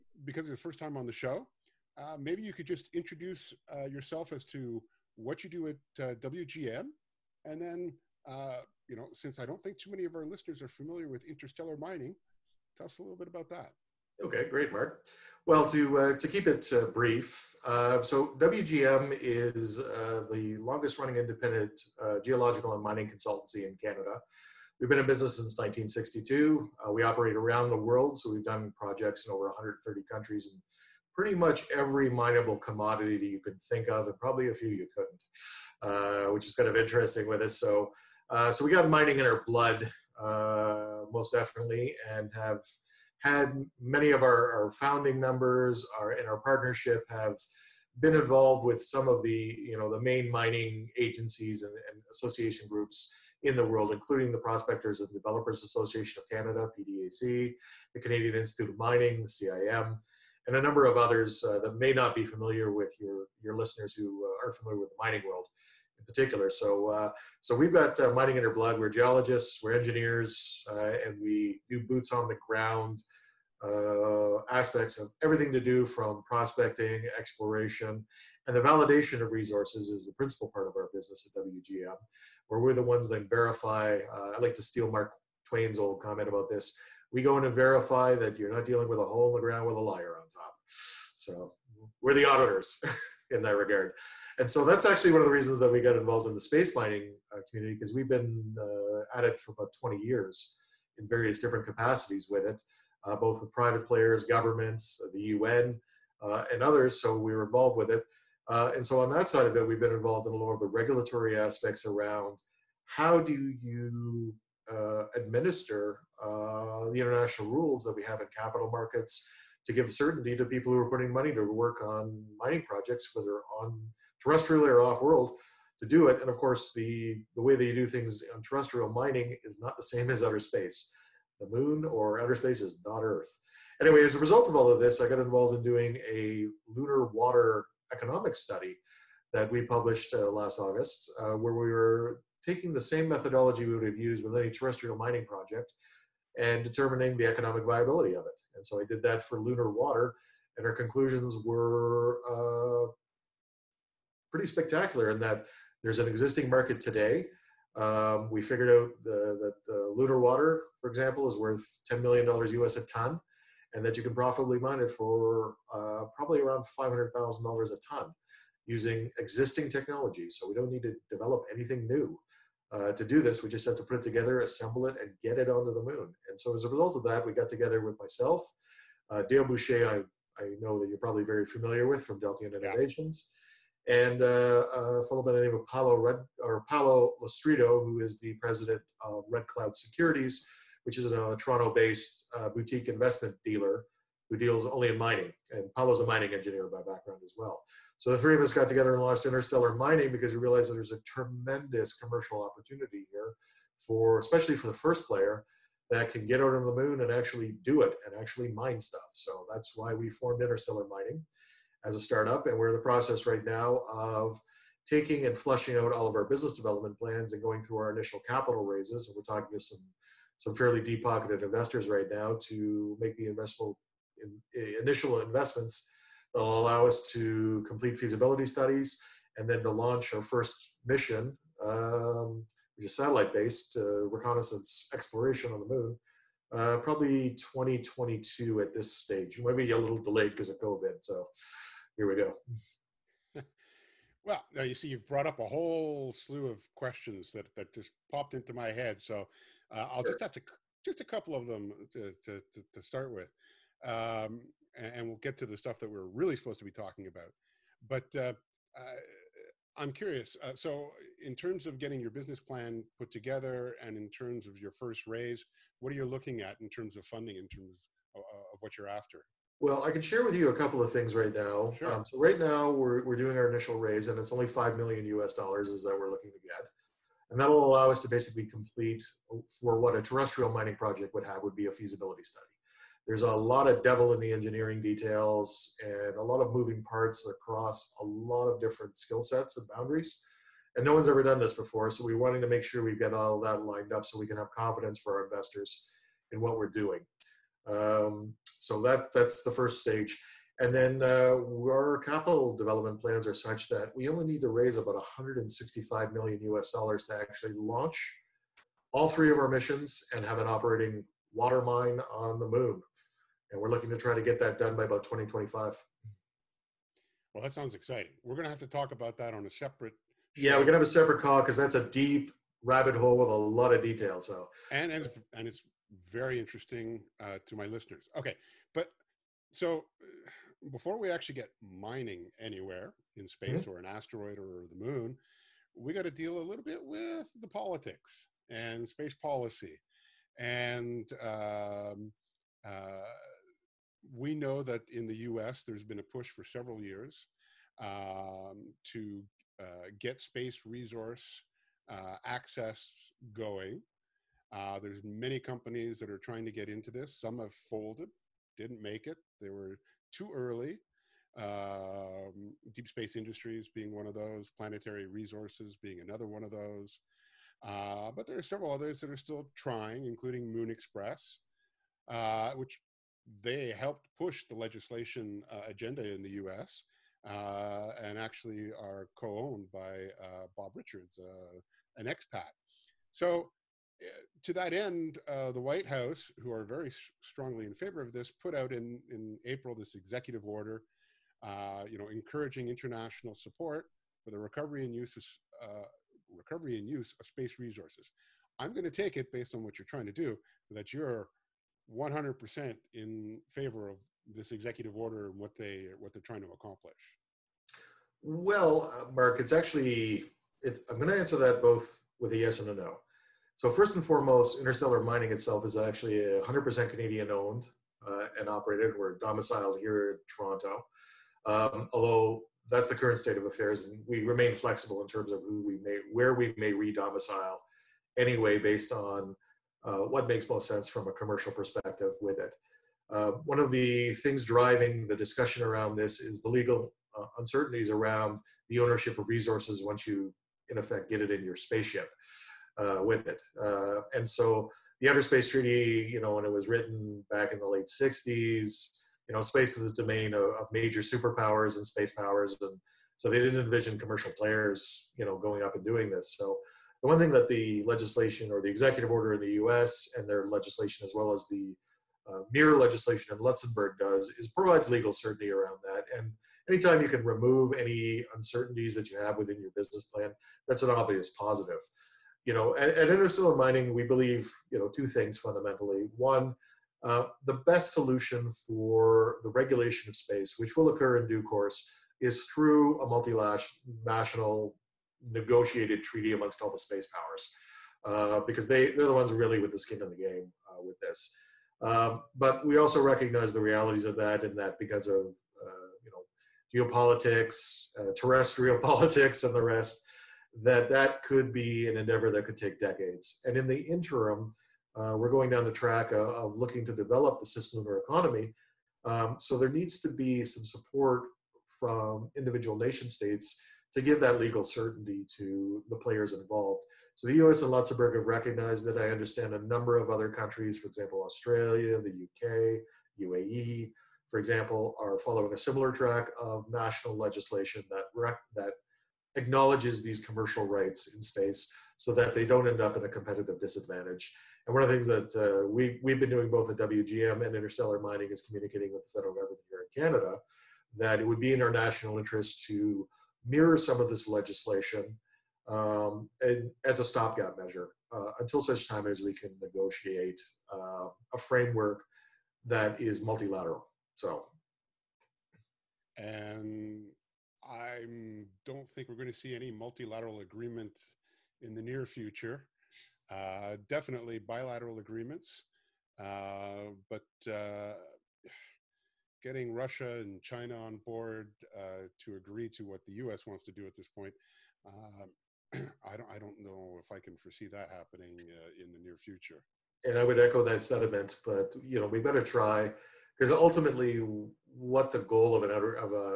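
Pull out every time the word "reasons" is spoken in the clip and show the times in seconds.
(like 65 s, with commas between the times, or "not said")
95 s.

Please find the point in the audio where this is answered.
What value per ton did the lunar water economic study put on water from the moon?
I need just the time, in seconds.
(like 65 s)
161 s.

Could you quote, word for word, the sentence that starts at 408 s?
Well, uh, Mark, it's actually it's, I'm going to answer that both with a yes and a no.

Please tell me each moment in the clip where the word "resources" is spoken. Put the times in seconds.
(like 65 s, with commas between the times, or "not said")
79 s, 350 s, 365 s, 397 s, 439 s.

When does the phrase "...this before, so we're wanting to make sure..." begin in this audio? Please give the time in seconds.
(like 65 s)
291 s.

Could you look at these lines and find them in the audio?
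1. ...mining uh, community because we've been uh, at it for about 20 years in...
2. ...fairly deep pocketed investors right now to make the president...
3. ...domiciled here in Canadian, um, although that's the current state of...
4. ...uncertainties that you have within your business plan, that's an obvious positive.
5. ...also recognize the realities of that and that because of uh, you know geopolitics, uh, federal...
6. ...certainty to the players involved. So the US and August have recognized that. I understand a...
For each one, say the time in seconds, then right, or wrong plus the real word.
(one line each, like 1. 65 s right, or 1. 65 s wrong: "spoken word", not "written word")
1. 96 s right
2. 220 s wrong: "investment", not "president"
3. 419 s wrong: "Toronto", not "Canadian"
4. 468 s right
5. 492 s wrong: "terrestrial", not "federal"
6. 514 s wrong: "Luxembourg", not "August".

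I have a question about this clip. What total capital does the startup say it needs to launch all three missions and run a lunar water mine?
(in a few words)
165 million US dollars.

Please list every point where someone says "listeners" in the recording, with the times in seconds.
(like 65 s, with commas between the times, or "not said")
10 s, 63 s, 327 s.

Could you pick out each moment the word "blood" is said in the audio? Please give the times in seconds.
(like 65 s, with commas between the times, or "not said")
39 s, 68 s.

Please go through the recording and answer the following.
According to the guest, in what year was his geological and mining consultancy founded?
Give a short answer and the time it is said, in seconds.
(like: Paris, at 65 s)
1962, at 25 s.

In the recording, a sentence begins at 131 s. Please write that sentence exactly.
The moon or outer space is not Earth.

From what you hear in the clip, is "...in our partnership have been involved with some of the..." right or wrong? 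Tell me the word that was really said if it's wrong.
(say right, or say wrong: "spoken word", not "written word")
right.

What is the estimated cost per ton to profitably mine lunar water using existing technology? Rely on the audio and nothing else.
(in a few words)
$500,000.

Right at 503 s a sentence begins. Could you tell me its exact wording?
And in the interim, uh, we're going down the track of, of, looking to develop the system of our economy.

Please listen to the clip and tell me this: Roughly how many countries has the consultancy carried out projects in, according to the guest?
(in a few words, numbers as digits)
over 130.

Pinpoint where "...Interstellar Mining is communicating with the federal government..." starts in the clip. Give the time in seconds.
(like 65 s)
537 s.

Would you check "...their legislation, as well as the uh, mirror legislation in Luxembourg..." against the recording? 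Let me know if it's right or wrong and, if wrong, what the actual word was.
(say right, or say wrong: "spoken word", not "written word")
right.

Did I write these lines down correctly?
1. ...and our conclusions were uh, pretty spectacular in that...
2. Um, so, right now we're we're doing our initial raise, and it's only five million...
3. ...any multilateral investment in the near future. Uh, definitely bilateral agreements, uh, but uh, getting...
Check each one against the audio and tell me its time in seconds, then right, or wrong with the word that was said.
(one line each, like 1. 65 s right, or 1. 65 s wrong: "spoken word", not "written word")
1. 150 s right
2. 271 s right
3. 559 s wrong: "agreement", not "investment".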